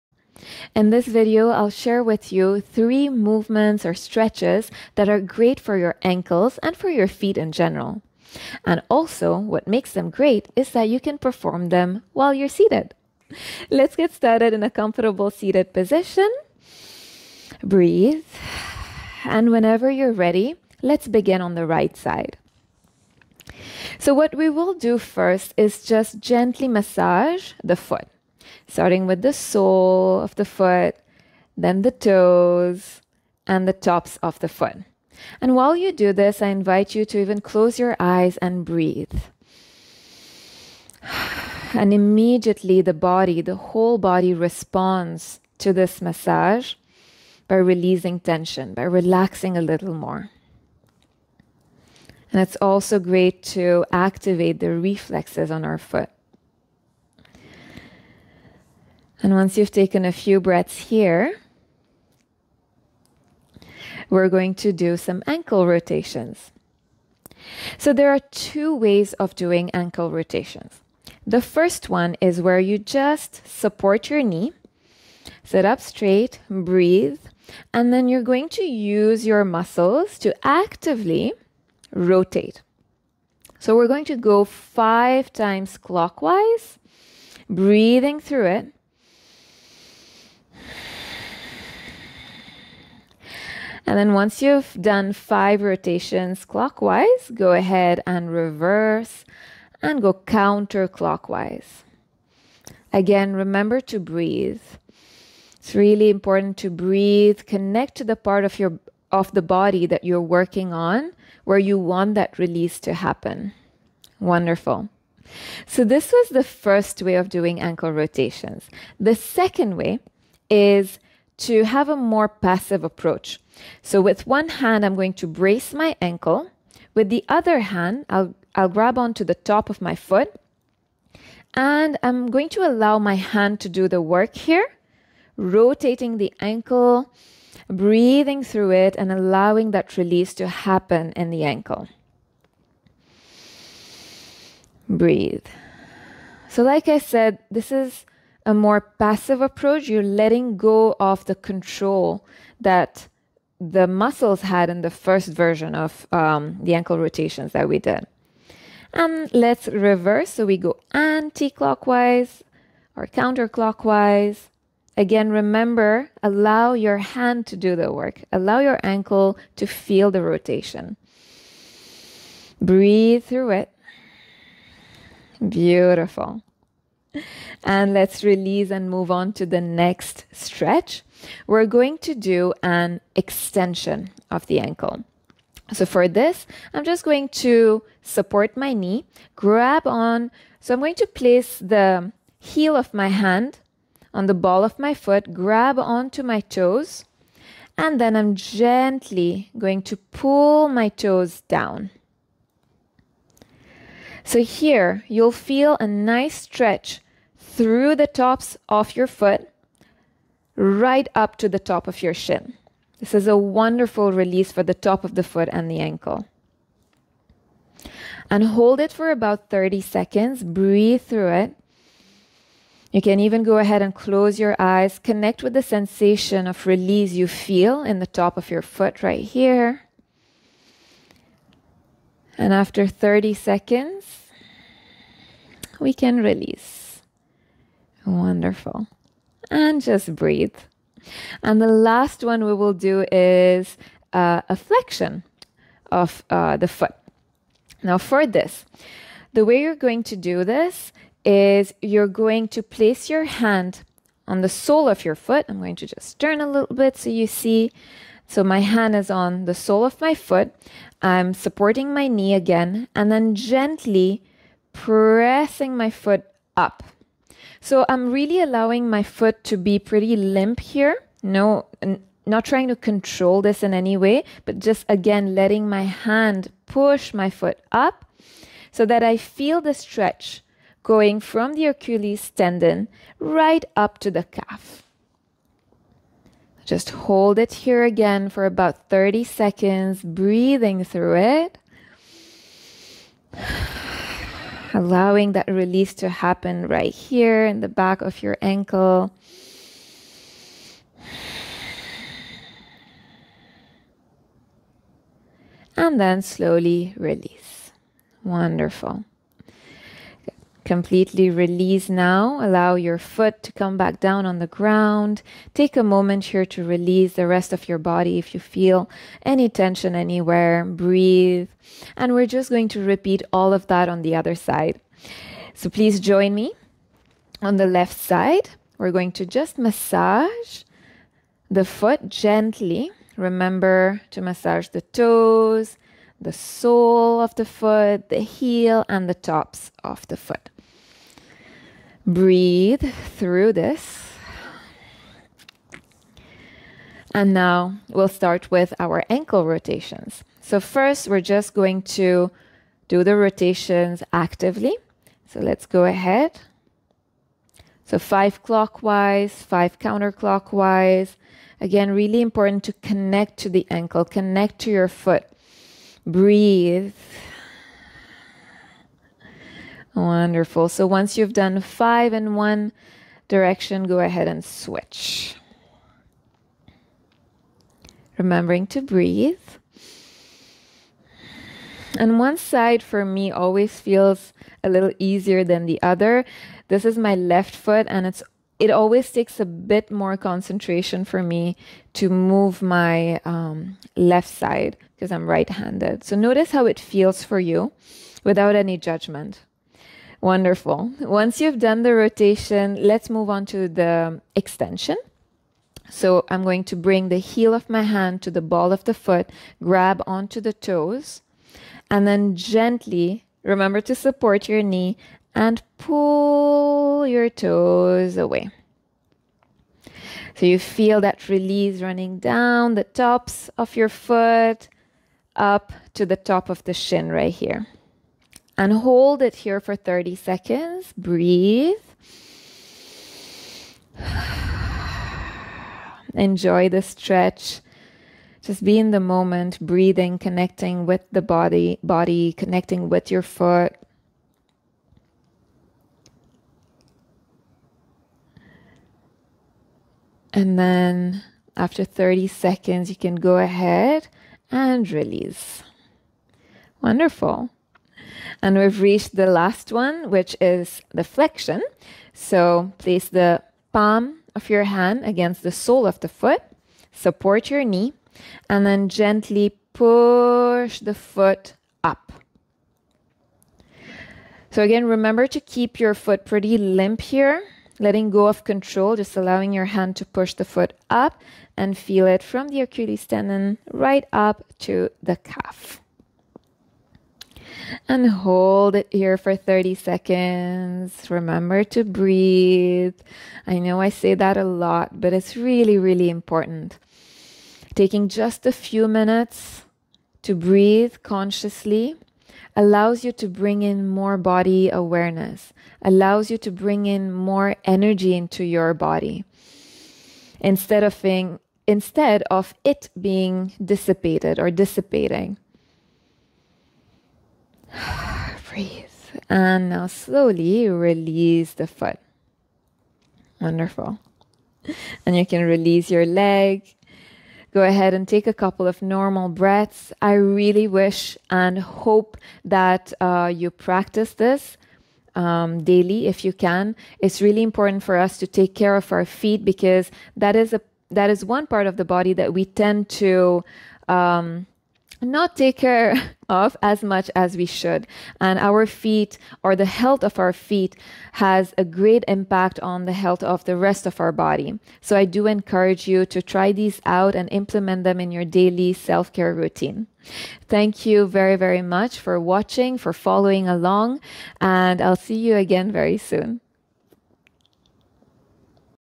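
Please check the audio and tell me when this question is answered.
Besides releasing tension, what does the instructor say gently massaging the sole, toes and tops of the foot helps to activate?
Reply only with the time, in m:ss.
0:54.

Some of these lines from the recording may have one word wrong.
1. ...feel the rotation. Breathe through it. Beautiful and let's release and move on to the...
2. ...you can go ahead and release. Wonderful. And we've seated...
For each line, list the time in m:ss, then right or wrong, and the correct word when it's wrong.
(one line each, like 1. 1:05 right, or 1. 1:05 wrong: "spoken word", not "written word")
1. 2:49 right
2. 7:32 wrong: "reached", not "seated".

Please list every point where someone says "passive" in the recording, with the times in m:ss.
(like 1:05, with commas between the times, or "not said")
2:02, 2:28.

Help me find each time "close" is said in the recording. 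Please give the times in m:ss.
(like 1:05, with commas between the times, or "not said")
0:37, 3:43.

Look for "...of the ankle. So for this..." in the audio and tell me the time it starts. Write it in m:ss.
3:04.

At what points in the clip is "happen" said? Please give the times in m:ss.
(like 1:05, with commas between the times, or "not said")
1:52, 2:20, 4:56.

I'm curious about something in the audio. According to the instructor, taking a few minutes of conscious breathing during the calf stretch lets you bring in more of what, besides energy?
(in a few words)
body awareness.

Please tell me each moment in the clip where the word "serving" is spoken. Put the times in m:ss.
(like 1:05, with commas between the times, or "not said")
not said.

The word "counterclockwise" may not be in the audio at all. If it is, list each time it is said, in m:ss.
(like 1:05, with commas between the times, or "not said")
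1:40, 2:43, 5:59.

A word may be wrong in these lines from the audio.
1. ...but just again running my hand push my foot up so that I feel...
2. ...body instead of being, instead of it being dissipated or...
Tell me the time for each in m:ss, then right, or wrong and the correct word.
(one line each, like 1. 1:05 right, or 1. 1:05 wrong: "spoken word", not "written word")
1. 4:34 wrong: "letting", not "running"
2. 8:28 right.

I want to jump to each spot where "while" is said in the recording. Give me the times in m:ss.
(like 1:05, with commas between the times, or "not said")
0:12, 0:35.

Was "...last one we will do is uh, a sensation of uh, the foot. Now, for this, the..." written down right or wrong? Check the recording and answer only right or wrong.
wrong.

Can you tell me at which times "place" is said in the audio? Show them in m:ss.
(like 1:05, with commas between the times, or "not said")
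3:11, 4:12, 7:42.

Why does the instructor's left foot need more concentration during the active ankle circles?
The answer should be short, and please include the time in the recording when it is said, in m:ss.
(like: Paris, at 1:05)
right handed, at 6:35.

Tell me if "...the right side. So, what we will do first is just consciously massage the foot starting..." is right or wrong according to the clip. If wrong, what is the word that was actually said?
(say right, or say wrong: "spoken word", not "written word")
wrong: "gently", not "consciously".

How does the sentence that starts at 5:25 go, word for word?
So please join me on the left side.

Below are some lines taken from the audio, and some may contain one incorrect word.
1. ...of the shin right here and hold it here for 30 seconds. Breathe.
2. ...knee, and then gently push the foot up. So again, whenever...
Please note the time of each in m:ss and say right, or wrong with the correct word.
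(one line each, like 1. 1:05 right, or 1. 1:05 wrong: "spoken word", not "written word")
1. 7:06 right
2. 7:47 wrong: "remember", not "whenever".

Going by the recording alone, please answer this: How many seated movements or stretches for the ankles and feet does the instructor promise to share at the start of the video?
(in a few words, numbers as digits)
3.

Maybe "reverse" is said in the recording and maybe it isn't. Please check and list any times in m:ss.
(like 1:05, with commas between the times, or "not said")
1:38, 2:39.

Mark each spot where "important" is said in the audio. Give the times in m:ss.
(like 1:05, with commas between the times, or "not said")
1:46, 6:02, 8:16, 8:57.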